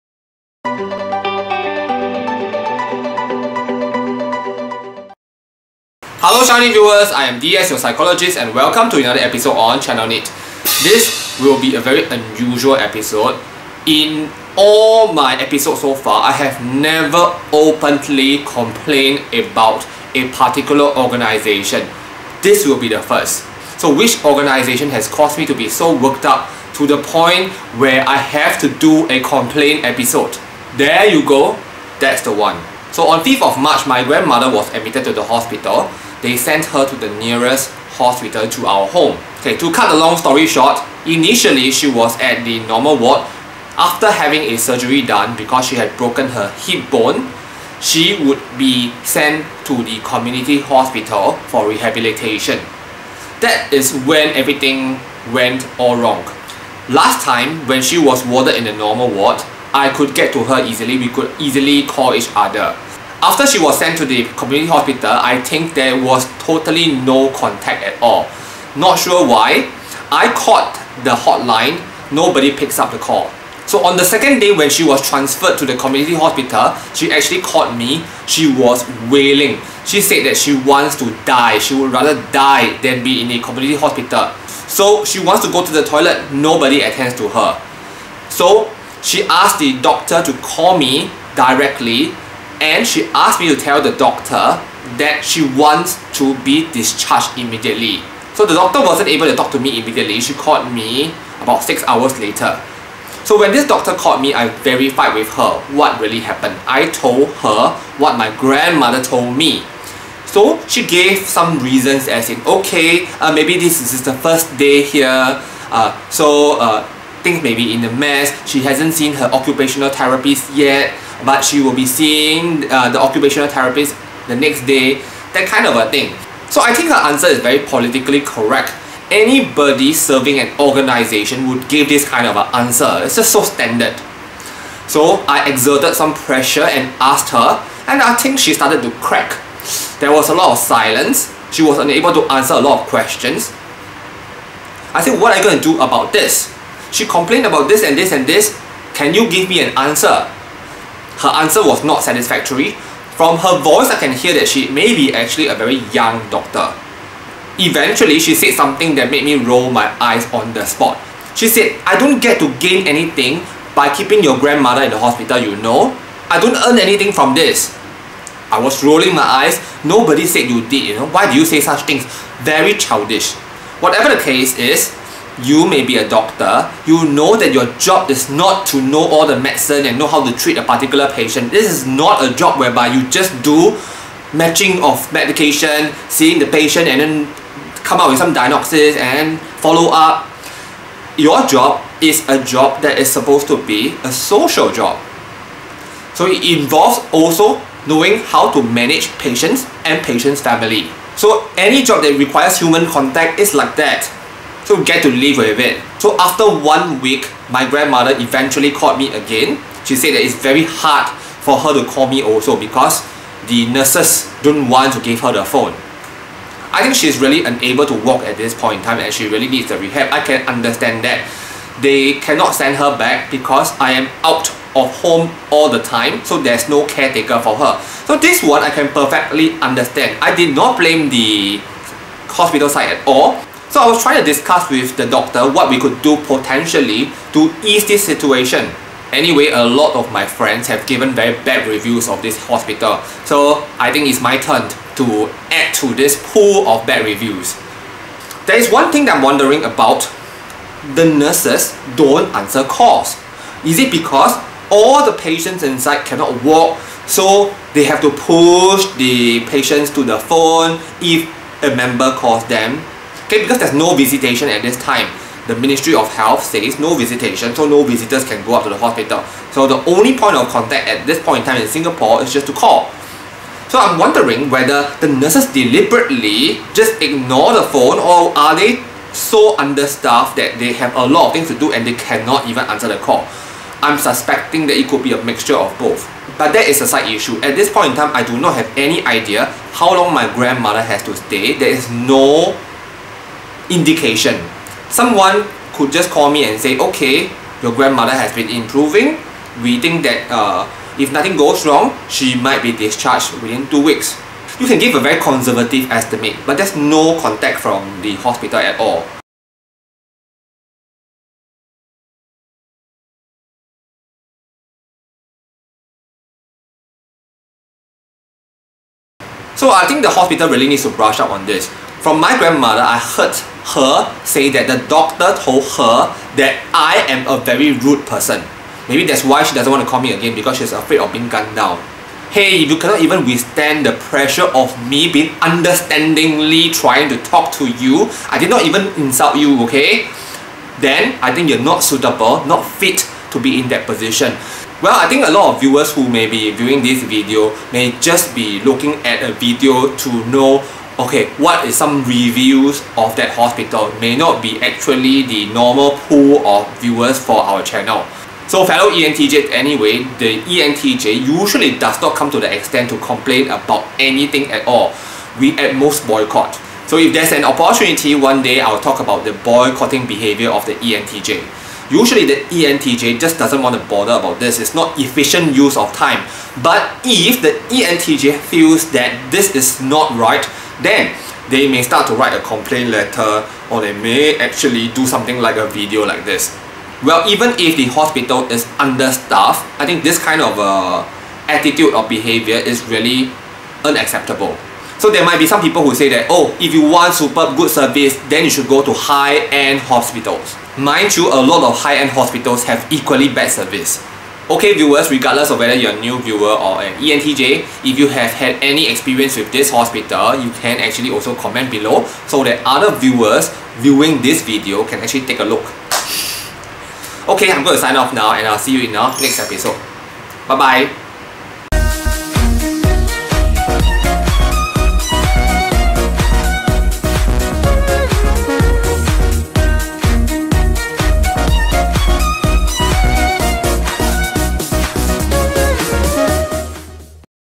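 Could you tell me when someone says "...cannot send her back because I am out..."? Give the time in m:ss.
3:42.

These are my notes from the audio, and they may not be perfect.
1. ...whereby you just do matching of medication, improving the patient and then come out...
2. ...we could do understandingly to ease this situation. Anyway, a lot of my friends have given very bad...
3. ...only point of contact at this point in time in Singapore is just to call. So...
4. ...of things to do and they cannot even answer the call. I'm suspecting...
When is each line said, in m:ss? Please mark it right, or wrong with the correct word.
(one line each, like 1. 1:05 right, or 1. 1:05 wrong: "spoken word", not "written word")
1. 3:02 wrong: "seeing", not "improving"
2. 3:55 wrong: "potentially", not "understandingly"
3. 4:29 right
4. 4:41 right.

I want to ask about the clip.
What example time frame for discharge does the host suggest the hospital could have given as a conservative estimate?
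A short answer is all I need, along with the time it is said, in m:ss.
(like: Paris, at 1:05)
Within 2 weeks, at 5:03.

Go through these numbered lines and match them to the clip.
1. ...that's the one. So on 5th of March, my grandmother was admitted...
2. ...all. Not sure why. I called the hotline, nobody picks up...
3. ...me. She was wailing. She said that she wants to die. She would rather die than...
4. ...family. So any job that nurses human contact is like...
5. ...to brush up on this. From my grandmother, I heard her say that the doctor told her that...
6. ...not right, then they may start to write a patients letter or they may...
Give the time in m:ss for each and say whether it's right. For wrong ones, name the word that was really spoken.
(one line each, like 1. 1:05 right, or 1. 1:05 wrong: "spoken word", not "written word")
1. 0:31 right
2. 1:08 right
3. 1:17 right
4. 3:20 wrong: "requires", not "nurses"
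5. 5:20 right
6. 6:19 wrong: "complaint", not "patients".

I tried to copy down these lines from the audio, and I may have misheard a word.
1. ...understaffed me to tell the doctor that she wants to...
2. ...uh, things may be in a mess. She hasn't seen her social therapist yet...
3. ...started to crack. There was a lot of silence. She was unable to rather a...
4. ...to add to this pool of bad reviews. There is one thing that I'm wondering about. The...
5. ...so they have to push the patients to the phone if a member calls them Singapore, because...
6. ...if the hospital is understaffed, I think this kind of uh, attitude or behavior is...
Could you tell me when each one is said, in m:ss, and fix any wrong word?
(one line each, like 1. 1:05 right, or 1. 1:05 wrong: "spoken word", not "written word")
1. 1:33 wrong: "asked", not "understaffed"
2. 1:56 wrong: "occupational", not "social"
3. 2:18 wrong: "answer", not "rather"
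4. 4:04 right
5. 4:17 wrong: "Okay", not "Singapore"
6. 6:27 right.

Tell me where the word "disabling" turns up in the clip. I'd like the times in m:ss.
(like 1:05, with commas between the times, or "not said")
not said.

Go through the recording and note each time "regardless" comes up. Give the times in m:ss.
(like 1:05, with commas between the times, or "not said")
6:45.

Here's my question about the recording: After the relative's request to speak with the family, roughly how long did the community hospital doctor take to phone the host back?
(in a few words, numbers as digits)
About 6 hours.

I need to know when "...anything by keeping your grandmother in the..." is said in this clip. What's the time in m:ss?
2:42.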